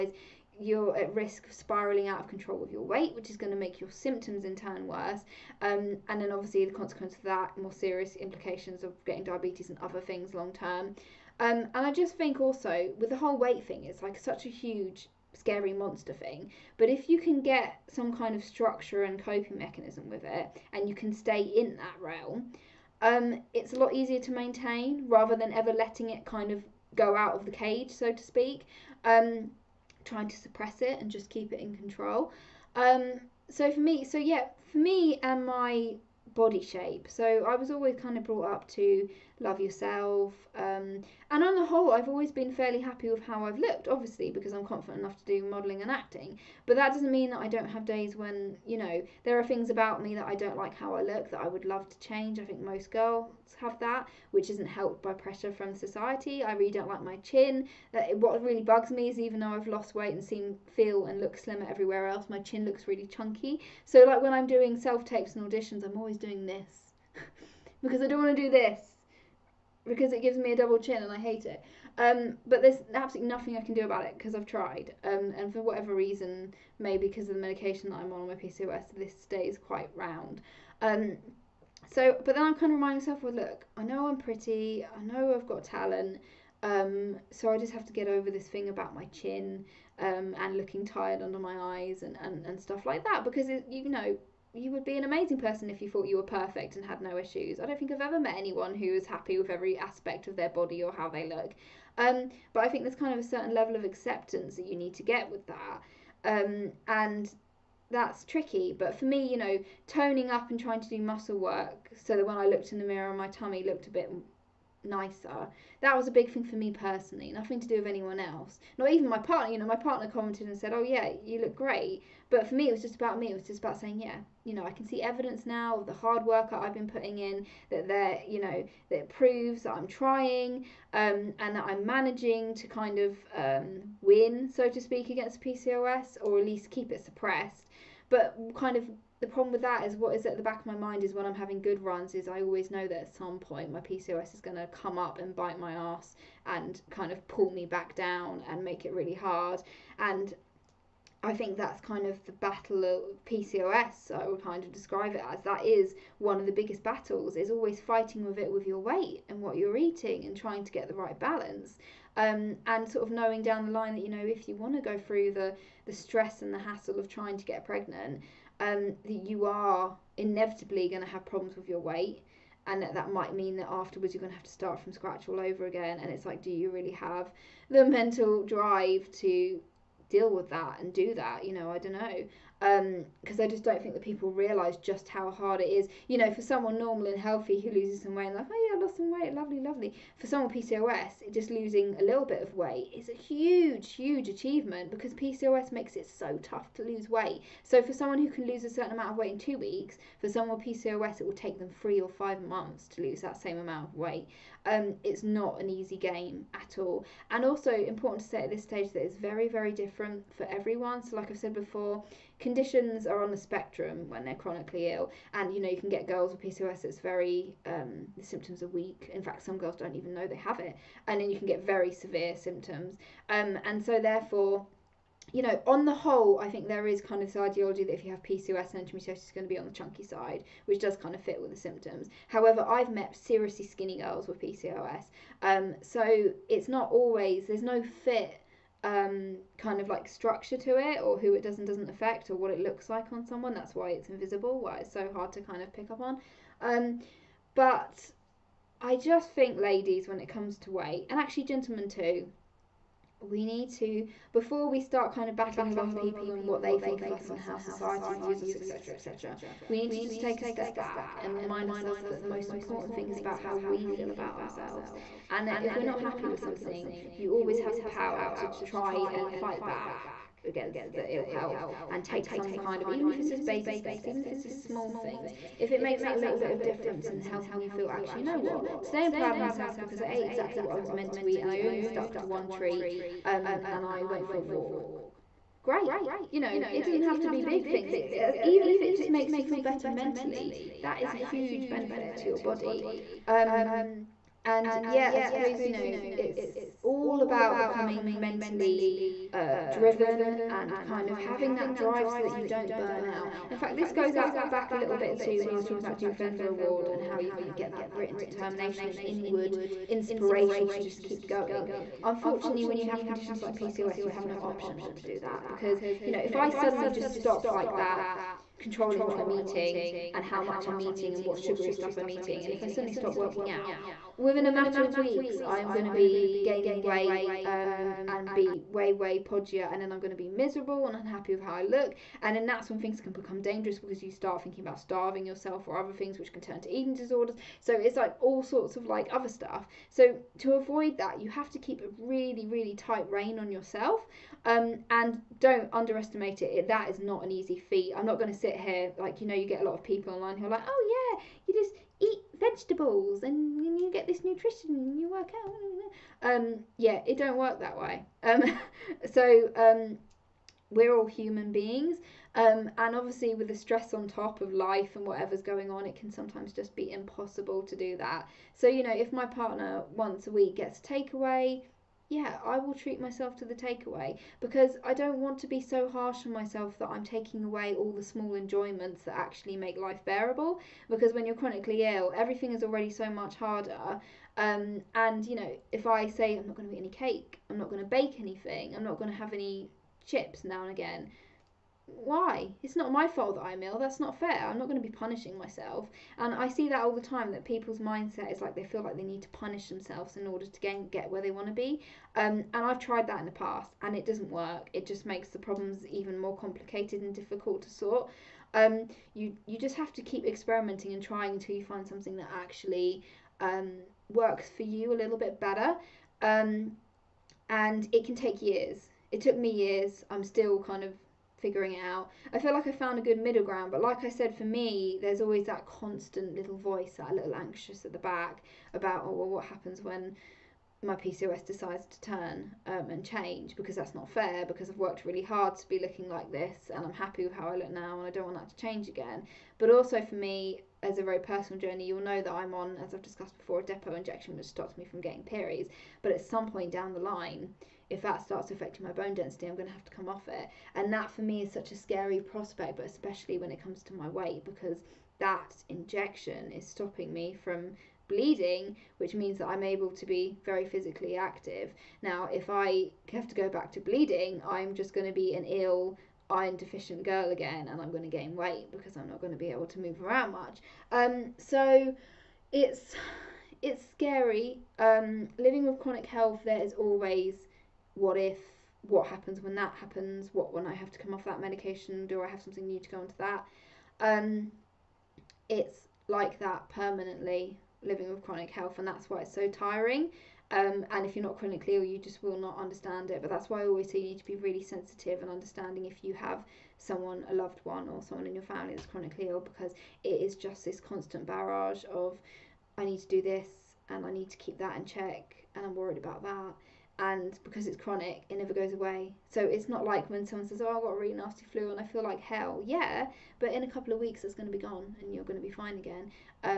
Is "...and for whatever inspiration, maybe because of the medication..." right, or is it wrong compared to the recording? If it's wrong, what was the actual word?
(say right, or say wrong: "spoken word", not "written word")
wrong: "reason", not "inspiration".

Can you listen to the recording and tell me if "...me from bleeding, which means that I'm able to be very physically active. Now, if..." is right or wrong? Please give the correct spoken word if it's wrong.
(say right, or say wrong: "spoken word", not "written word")
right.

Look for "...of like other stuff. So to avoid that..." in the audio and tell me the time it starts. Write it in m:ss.
5:38.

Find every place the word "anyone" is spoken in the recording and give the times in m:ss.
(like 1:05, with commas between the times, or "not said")
1:38, 1:57.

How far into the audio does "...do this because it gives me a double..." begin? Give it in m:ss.
1:08.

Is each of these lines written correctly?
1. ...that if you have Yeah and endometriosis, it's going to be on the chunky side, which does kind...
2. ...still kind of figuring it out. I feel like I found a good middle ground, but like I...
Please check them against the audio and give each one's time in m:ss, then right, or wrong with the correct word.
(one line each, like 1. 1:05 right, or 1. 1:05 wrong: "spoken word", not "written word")
1. 3:47 wrong: "PCOS", not "Yeah"
2. 7:00 right.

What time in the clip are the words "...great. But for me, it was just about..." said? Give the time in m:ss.
2:01.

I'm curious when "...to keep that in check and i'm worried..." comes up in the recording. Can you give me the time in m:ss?
8:24.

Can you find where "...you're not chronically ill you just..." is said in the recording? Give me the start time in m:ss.
8:11.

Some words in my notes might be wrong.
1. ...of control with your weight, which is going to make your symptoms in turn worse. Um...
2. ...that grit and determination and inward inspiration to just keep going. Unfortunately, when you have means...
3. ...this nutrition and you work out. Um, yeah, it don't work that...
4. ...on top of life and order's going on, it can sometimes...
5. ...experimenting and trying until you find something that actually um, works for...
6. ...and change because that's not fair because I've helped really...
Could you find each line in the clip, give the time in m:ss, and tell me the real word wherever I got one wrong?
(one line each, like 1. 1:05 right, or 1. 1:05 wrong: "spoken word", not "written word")
1. 0:02 right
2. 5:07 wrong: "conditions", not "means"
3. 5:54 right
4. 6:03 wrong: "whatever", not "order"
5. 6:50 right
6. 7:12 wrong: "worked", not "helped".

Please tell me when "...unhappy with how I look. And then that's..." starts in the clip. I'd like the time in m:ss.
5:30.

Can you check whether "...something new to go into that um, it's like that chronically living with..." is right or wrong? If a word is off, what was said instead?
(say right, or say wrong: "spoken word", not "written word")
wrong: "permanently", not "chronically".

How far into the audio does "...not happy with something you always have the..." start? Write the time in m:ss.
4:25.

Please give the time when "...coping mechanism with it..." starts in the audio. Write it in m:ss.
0:19.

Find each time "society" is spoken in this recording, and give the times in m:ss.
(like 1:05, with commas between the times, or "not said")
0:55, 4:17.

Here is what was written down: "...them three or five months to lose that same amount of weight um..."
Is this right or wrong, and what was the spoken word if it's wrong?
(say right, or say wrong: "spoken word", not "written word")
right.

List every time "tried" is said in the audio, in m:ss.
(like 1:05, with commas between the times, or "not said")
1:14, 6:42.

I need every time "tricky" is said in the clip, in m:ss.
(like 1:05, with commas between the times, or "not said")
1:48.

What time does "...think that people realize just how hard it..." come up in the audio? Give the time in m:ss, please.
3:03.